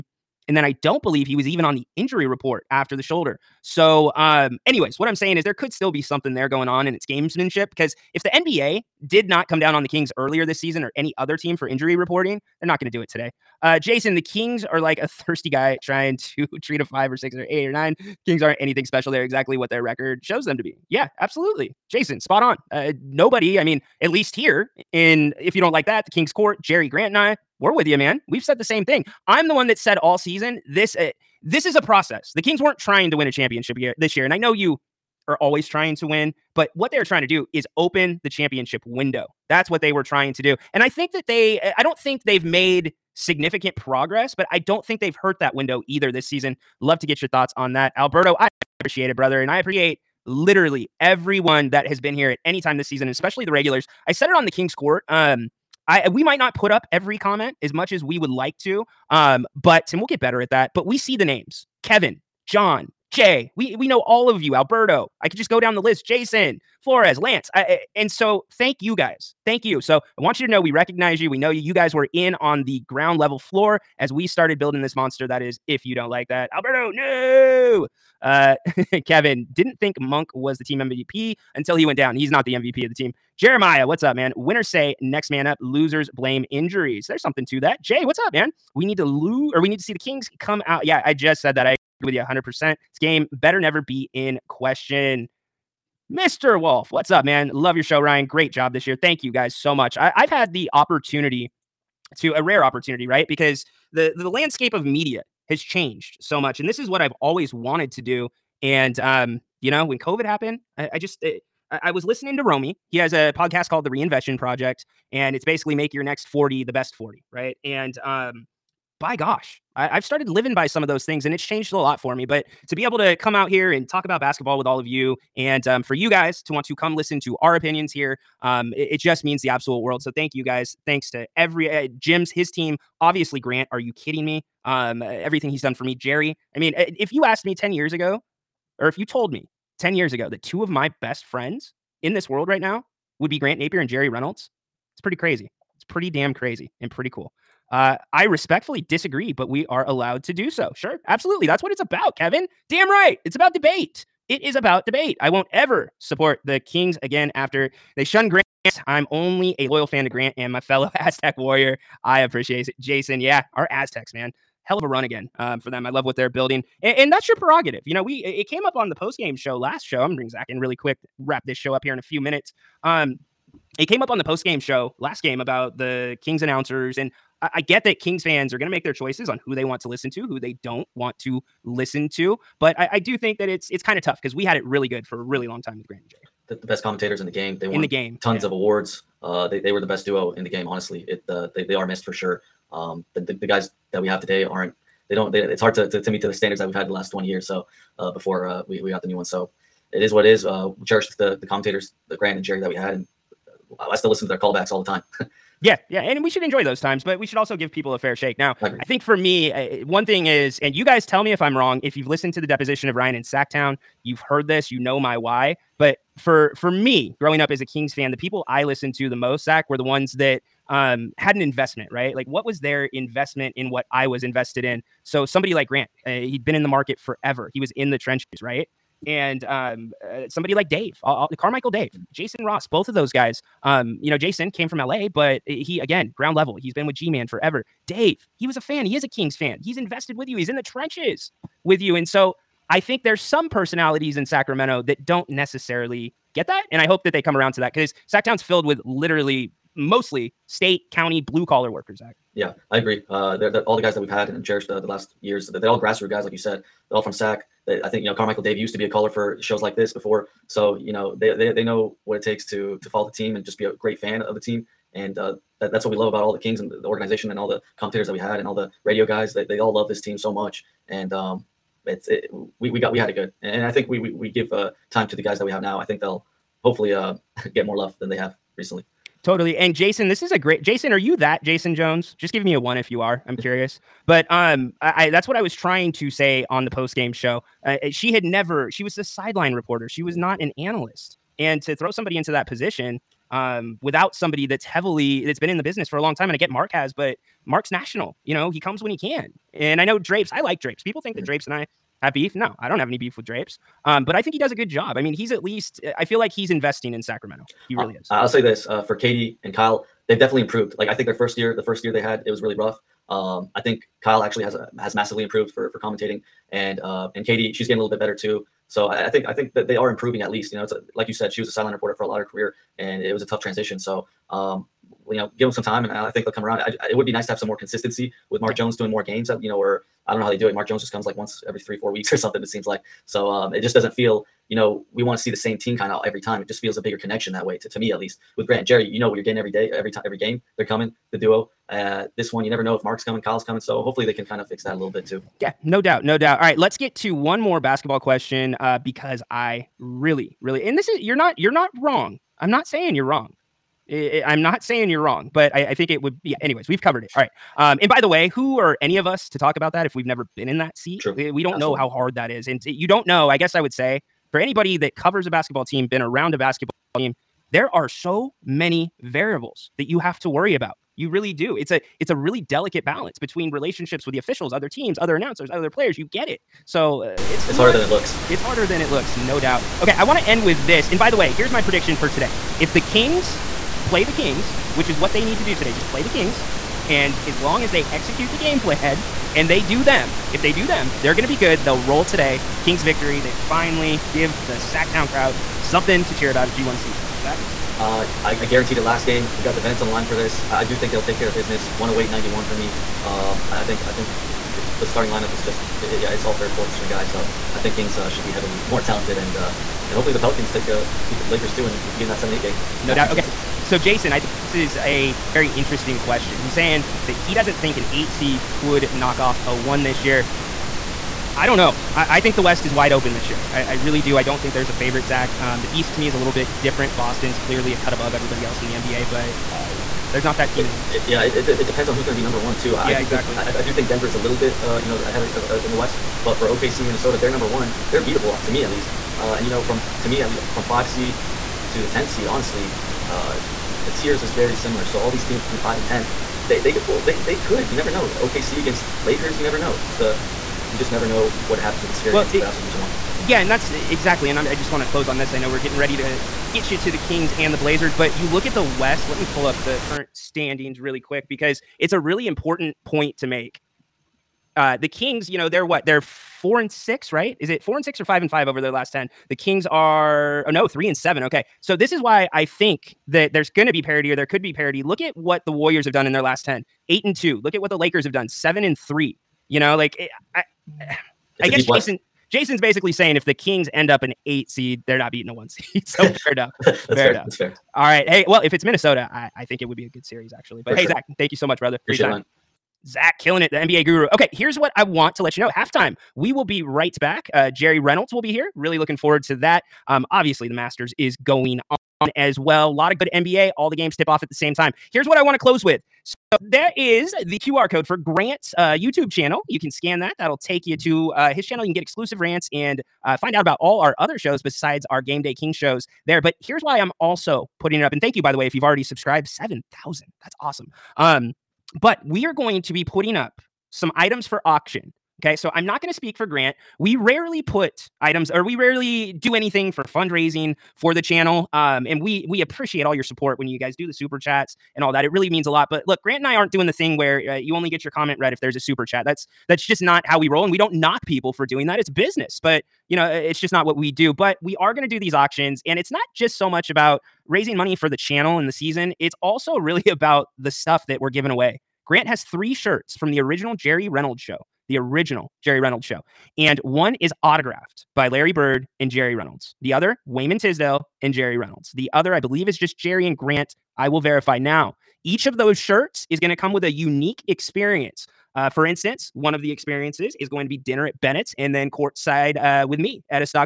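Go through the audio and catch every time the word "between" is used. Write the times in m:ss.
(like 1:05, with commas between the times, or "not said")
6:13, 7:25.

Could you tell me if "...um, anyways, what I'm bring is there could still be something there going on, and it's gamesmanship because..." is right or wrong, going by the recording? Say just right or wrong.
wrong.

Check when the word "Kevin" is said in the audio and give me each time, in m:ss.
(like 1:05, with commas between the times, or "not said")
1:01, 1:19, 2:32.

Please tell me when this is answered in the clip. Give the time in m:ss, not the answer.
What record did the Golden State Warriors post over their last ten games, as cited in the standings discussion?
7:56.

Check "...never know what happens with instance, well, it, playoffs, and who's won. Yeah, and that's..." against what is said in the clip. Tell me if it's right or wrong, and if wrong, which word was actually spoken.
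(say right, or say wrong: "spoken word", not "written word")
wrong: "experience", not "instance".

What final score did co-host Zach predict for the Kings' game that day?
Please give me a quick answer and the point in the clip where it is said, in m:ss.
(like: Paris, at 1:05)
108-91, at 6:41.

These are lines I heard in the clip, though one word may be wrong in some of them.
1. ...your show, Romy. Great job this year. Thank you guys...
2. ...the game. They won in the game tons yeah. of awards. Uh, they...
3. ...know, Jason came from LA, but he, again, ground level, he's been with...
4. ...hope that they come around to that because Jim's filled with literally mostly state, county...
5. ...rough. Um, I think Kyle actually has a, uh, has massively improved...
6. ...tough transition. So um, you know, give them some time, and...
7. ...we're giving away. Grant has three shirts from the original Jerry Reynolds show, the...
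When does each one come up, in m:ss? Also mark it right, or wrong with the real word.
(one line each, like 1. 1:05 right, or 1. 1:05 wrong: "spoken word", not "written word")
1. 1:37 wrong: "Ryan", not "Romy"
2. 3:07 right
3. 3:54 right
4. 4:06 wrong: "Sacktown", not "Jim"
5. 5:12 right
6. 5:23 right
7. 9:10 right.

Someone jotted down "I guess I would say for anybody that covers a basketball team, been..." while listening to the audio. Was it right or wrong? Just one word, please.
right.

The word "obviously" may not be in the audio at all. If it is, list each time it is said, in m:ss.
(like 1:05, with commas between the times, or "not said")
2:13, 8:20.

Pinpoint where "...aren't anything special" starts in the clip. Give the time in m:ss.
0:18.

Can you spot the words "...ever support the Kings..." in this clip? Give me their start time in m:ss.
2:35.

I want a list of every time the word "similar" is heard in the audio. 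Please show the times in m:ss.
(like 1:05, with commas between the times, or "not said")
7:24.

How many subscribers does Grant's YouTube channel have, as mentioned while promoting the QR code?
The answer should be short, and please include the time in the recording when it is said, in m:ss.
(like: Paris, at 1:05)
7,000, at 8:39.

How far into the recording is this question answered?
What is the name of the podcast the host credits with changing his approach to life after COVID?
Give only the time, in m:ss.
1:53.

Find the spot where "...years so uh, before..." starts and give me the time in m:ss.
3:17.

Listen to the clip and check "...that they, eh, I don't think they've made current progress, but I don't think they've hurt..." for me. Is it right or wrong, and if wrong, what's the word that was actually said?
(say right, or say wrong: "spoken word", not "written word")
wrong: "significant", not "current".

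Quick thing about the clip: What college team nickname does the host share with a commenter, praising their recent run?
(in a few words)
Aztecs.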